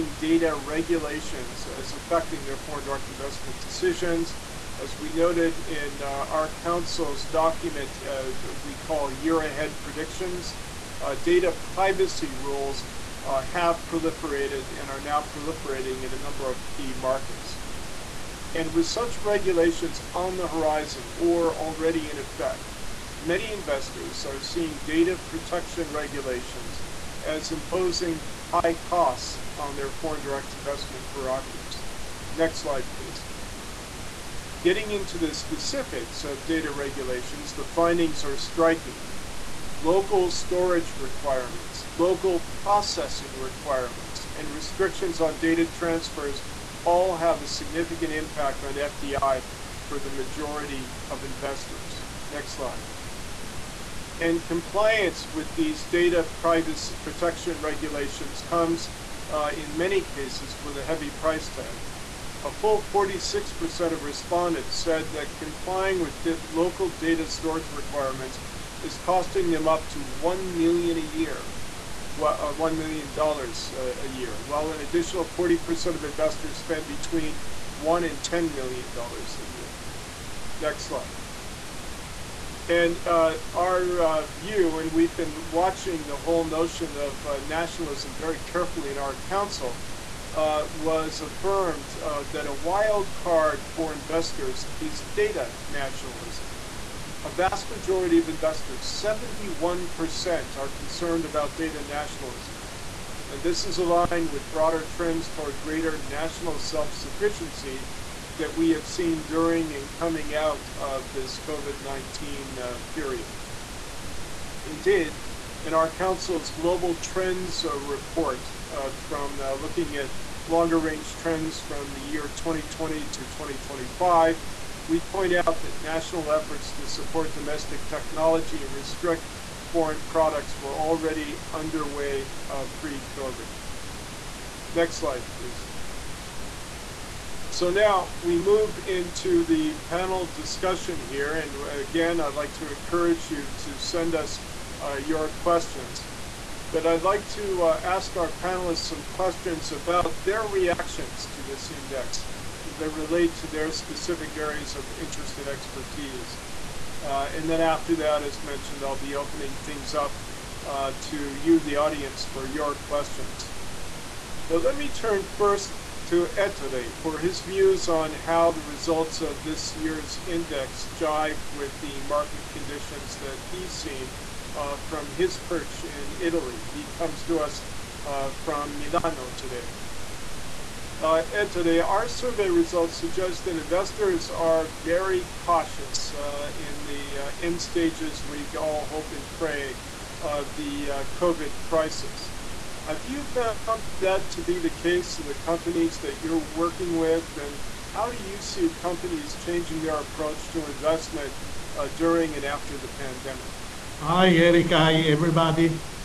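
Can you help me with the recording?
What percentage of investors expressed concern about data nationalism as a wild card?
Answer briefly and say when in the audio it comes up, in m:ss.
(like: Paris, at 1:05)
71%, at 1:39.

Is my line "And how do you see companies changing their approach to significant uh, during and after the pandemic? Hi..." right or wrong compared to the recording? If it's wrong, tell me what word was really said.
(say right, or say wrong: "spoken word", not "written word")
wrong: "investment", not "significant".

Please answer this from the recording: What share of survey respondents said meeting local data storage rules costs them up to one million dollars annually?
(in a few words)
46%.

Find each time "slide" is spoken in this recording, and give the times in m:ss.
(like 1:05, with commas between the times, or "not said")
0:32, 0:52, 1:20, 2:14.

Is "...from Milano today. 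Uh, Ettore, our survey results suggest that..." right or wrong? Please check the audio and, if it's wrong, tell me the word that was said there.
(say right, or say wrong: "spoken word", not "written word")
right.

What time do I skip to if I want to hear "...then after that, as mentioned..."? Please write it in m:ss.
2:37.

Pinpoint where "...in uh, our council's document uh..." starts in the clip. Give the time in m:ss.
0:05.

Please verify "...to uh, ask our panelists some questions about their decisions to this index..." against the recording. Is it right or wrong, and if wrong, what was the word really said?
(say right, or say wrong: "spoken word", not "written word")
wrong: "reactions", not "decisions".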